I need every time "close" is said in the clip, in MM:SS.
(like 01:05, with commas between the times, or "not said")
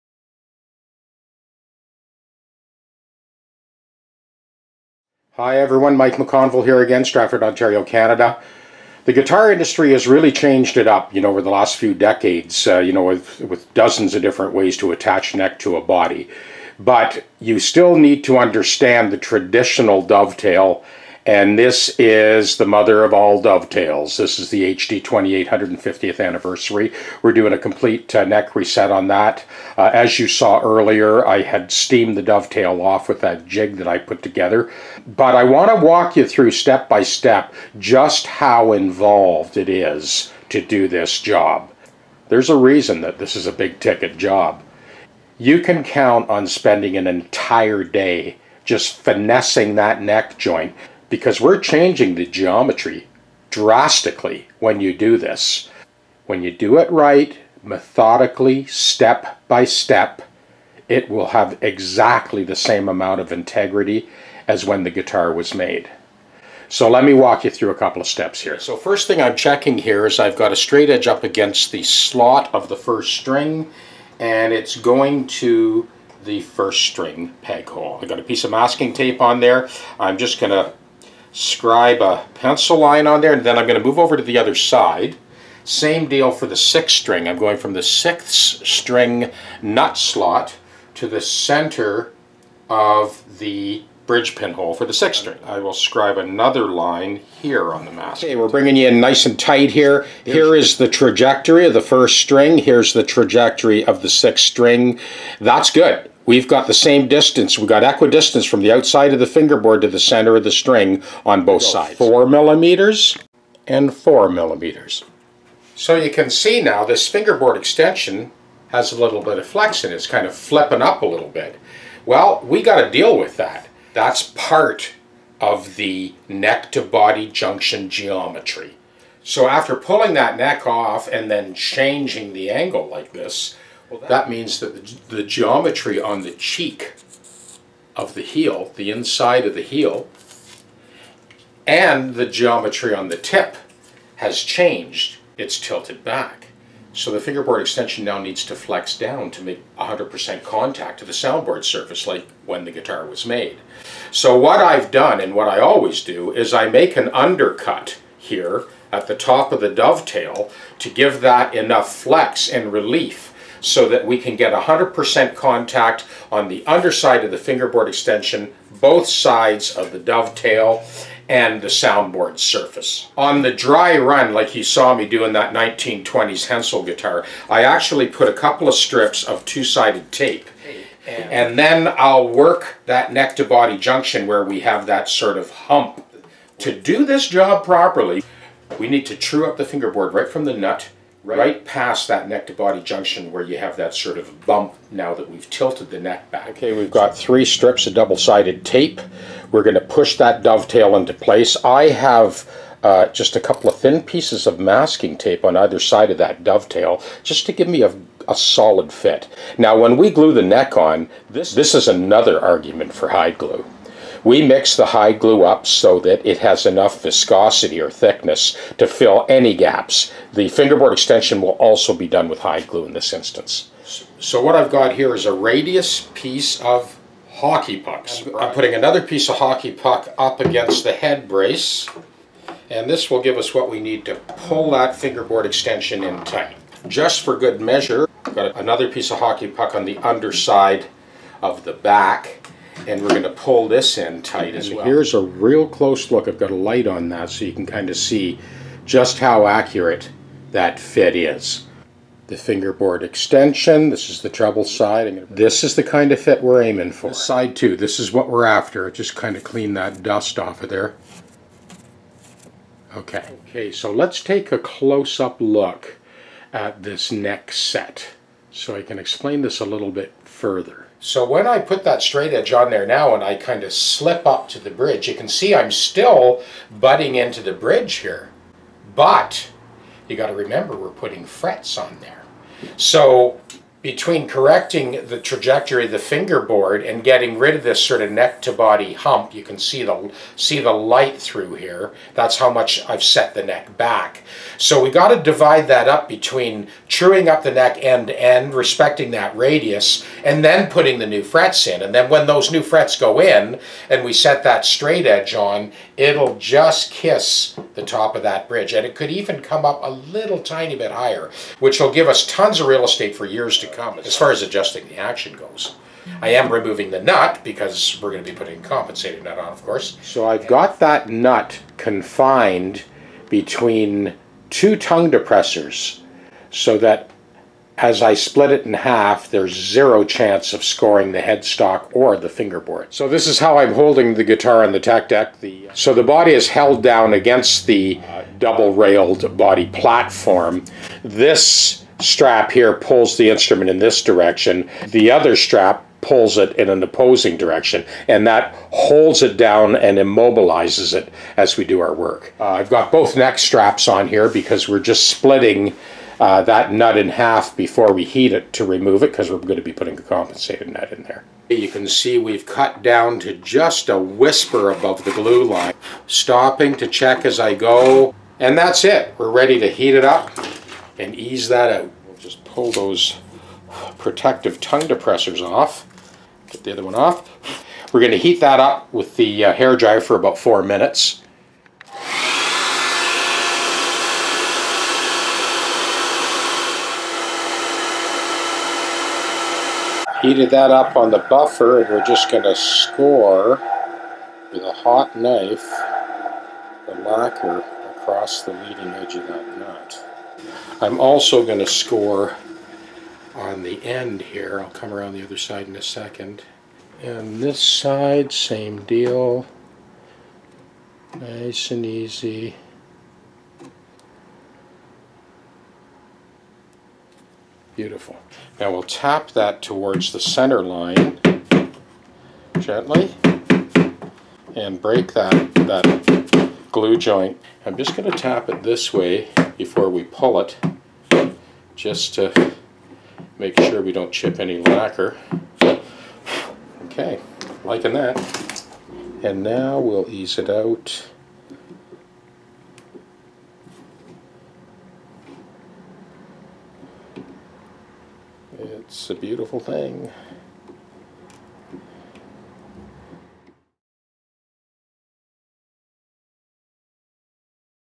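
04:05, 04:24.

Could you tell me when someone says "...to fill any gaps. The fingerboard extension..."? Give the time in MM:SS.
03:38.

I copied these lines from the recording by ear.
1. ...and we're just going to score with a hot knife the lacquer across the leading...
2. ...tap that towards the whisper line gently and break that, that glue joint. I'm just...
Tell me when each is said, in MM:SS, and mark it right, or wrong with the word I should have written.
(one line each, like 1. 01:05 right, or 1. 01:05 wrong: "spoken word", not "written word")
1. 06:31 right
2. 06:58 wrong: "center", not "whisper".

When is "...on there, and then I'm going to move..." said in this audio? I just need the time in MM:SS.
01:23.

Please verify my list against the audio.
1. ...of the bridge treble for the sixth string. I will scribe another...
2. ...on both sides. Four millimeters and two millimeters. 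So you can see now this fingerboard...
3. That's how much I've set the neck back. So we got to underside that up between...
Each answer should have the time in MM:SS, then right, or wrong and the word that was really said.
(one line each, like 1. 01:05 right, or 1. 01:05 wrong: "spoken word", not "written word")
1. 01:32 wrong: "pinhole", not "treble"
2. 01:51 wrong: "four", not "two"
3. 04:52 wrong: "divide", not "underside".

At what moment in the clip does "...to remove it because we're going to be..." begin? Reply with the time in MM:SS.
05:58.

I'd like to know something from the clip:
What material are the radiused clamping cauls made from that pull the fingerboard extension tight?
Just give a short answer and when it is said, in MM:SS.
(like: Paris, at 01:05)
Hockey pucks, at 03:47.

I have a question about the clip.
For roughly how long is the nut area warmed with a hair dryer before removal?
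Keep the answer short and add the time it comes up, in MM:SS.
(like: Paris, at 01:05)
4 minutes, at 06:20.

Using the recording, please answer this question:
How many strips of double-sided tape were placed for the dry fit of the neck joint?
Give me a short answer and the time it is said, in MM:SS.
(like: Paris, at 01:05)
3, at 03:17.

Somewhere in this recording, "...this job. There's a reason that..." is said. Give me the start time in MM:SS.
00:40.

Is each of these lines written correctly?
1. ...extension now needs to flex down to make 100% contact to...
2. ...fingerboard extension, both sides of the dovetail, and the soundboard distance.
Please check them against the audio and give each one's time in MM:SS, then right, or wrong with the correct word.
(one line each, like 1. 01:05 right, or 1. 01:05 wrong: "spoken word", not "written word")
1. 02:27 right
2. 02:47 wrong: "surface", not "distance".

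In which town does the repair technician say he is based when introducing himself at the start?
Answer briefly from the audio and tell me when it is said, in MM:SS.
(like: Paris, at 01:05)
Stratford, Ontario, at 00:07.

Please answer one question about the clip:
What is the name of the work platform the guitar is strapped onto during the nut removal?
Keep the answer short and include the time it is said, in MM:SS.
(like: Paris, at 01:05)
TechDeck, at 05:34.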